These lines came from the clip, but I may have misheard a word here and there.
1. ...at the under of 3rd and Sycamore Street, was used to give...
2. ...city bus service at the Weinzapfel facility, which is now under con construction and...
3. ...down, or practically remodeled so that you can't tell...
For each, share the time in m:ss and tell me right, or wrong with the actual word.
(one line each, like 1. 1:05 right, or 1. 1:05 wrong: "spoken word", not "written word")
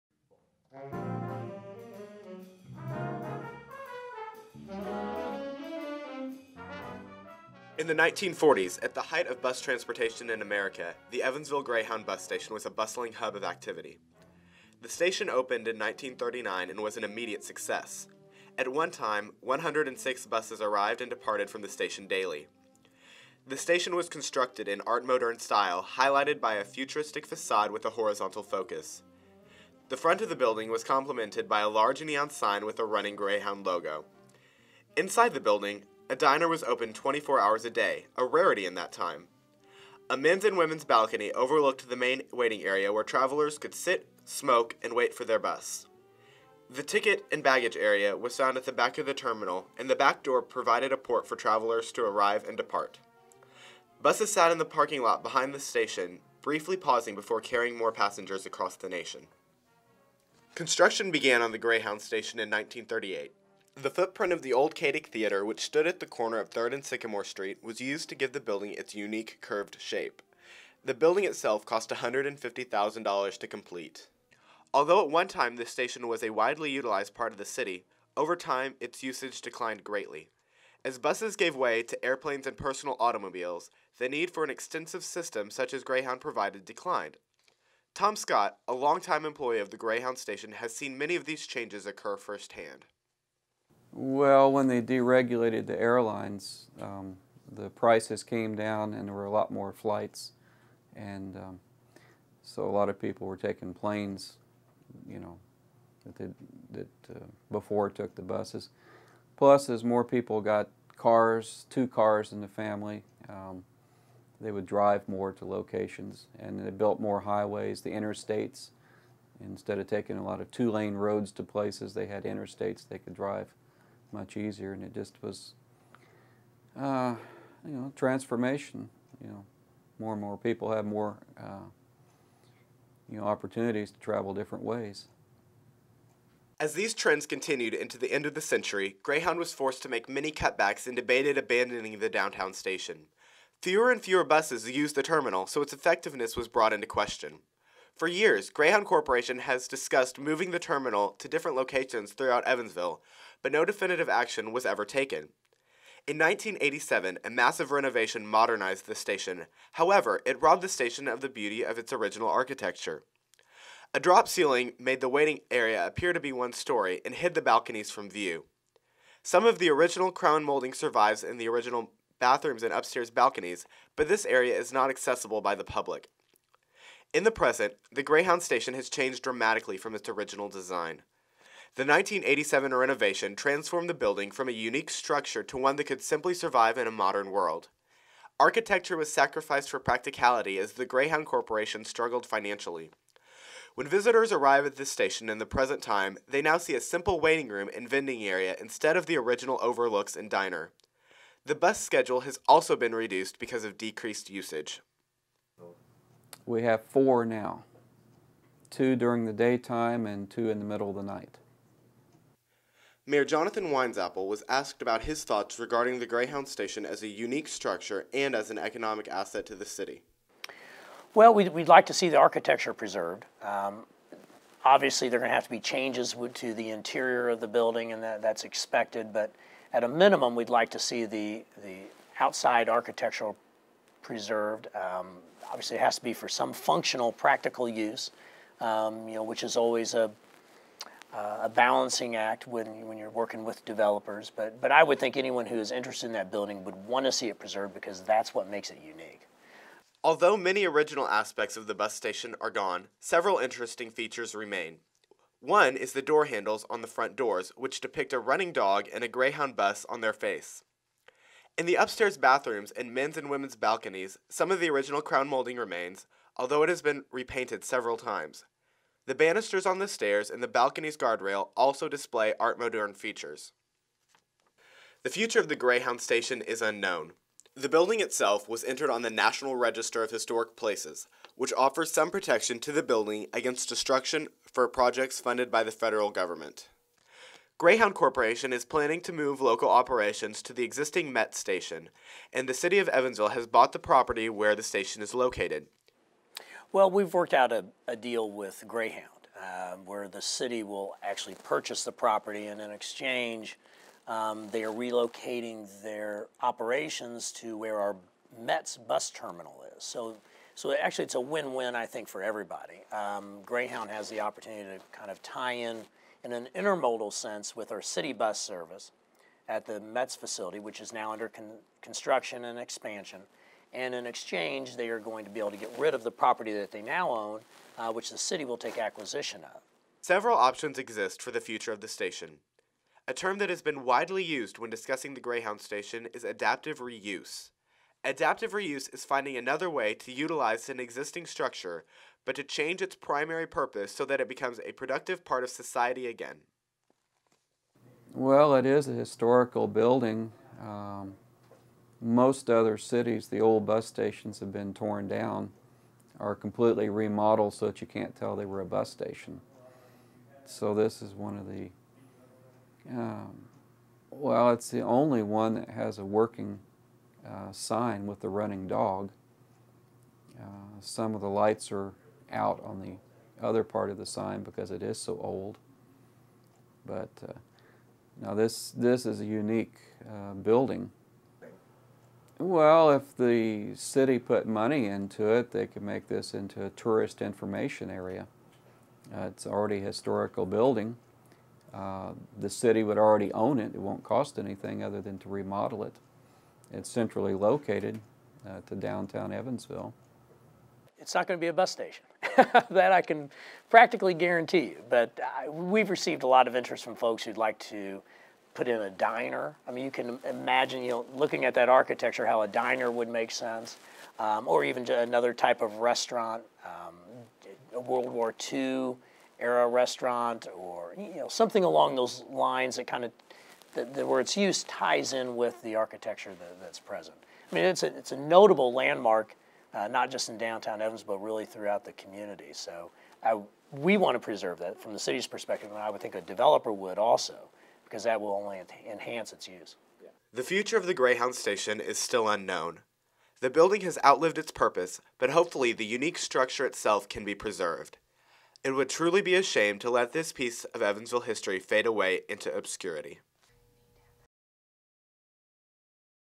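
1. 1:05 wrong: "corner", not "under"
2. 5:17 wrong: "Mets", not "Weinzapfel"
3. 5:55 wrong: "completely", not "practically".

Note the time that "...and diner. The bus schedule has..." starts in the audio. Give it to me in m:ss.
3:20.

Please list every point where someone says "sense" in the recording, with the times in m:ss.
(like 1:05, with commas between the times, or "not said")
5:17, 6:53.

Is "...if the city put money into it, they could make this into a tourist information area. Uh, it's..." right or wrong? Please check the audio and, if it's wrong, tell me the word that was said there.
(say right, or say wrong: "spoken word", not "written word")
right.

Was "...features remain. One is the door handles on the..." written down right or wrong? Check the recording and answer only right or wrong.
right.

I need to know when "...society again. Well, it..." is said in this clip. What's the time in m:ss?
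5:45.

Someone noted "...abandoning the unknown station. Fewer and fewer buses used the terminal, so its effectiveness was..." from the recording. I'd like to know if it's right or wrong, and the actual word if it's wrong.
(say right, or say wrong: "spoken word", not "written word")
wrong: "downtown", not "unknown".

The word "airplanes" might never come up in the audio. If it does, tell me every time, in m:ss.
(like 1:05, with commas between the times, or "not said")
1:22.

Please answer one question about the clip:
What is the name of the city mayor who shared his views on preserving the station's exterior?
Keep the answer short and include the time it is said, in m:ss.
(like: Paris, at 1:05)
Jonathan Weinzapfel, at 3:33.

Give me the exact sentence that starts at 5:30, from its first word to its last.
Several options exist for the future of the station.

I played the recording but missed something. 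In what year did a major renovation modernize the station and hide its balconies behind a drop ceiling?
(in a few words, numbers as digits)
1987.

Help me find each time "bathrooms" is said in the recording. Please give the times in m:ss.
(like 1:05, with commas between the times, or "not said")
2:52, 4:22.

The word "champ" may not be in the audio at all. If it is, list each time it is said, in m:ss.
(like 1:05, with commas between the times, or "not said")
not said.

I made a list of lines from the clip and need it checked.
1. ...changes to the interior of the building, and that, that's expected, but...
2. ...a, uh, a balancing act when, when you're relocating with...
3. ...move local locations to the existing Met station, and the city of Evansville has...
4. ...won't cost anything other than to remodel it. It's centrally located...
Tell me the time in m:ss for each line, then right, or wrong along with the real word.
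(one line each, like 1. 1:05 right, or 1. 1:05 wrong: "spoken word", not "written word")
1. 3:45 right
2. 3:59 wrong: "working", not "relocating"
3. 4:49 wrong: "operations", not "locations"
4. 6:33 right.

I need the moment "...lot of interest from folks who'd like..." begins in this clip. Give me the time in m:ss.
6:46.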